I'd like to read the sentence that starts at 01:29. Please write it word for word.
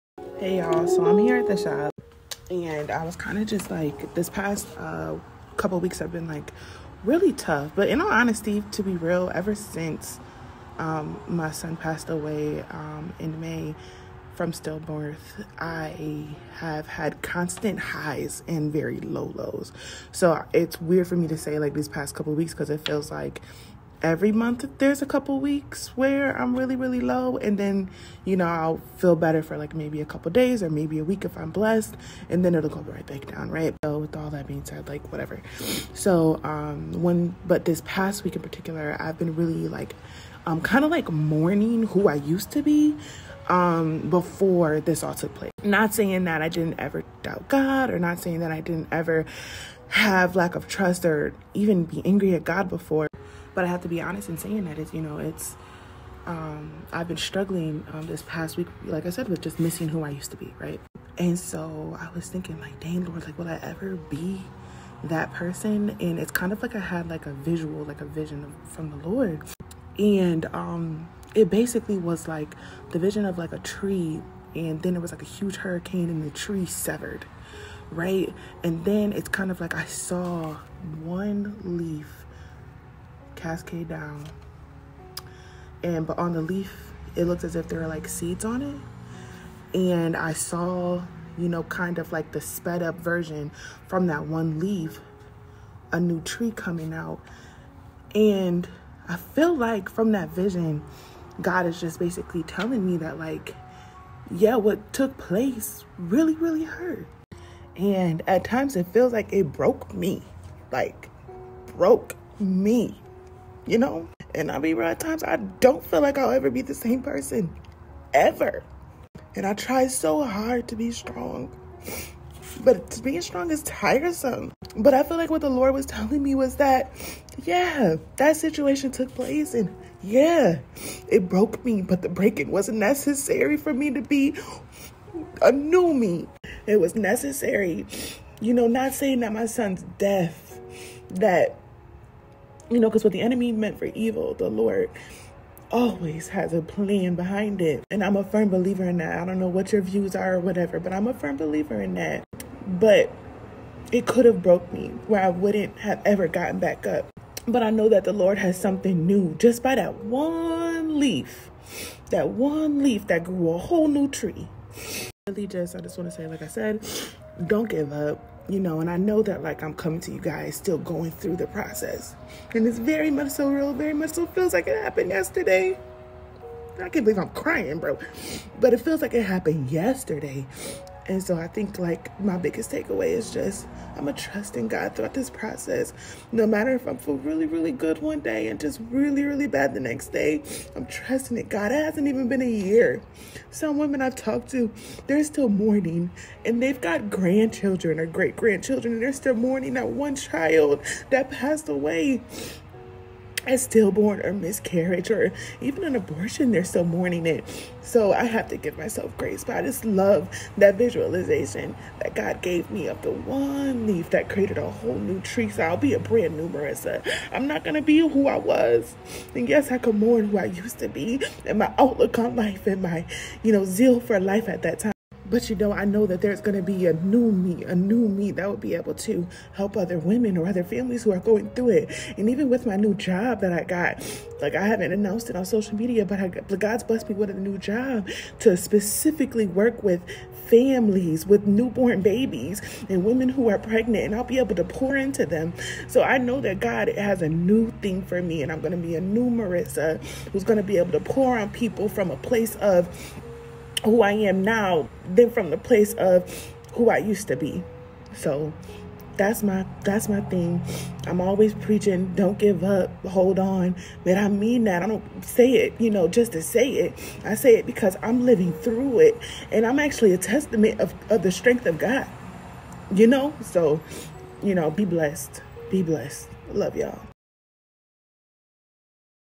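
And I saw, you know, kind of like the sped up version from that one leaf, a new tree coming out.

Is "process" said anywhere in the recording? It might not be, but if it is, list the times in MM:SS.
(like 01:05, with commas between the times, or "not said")
02:51, 03:05.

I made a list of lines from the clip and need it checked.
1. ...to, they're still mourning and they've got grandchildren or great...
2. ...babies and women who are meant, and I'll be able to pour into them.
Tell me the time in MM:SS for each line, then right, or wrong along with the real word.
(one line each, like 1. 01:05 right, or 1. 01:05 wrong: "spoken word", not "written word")
1. 03:14 right
2. 04:02 wrong: "pregnant", not "meant".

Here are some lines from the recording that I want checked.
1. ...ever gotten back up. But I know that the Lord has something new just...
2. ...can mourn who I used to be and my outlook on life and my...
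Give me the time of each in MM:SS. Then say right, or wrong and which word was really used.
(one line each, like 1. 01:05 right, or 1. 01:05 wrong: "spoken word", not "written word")
1. 02:36 right
2. 03:39 right.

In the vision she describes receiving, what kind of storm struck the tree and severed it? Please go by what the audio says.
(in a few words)
Hurricane.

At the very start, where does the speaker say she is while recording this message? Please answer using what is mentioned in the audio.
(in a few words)
the shop.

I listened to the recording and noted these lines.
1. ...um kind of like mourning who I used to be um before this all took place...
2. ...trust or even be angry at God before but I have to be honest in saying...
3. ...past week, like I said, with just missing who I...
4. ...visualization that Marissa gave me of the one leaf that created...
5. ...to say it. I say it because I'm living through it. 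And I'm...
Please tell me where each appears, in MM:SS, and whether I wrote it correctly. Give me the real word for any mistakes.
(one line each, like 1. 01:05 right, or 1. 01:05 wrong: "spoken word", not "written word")
1. 00:40 right
2. 00:50 right
3. 00:58 right
4. 03:30 wrong: "God", not "Marissa"
5. 04:26 right.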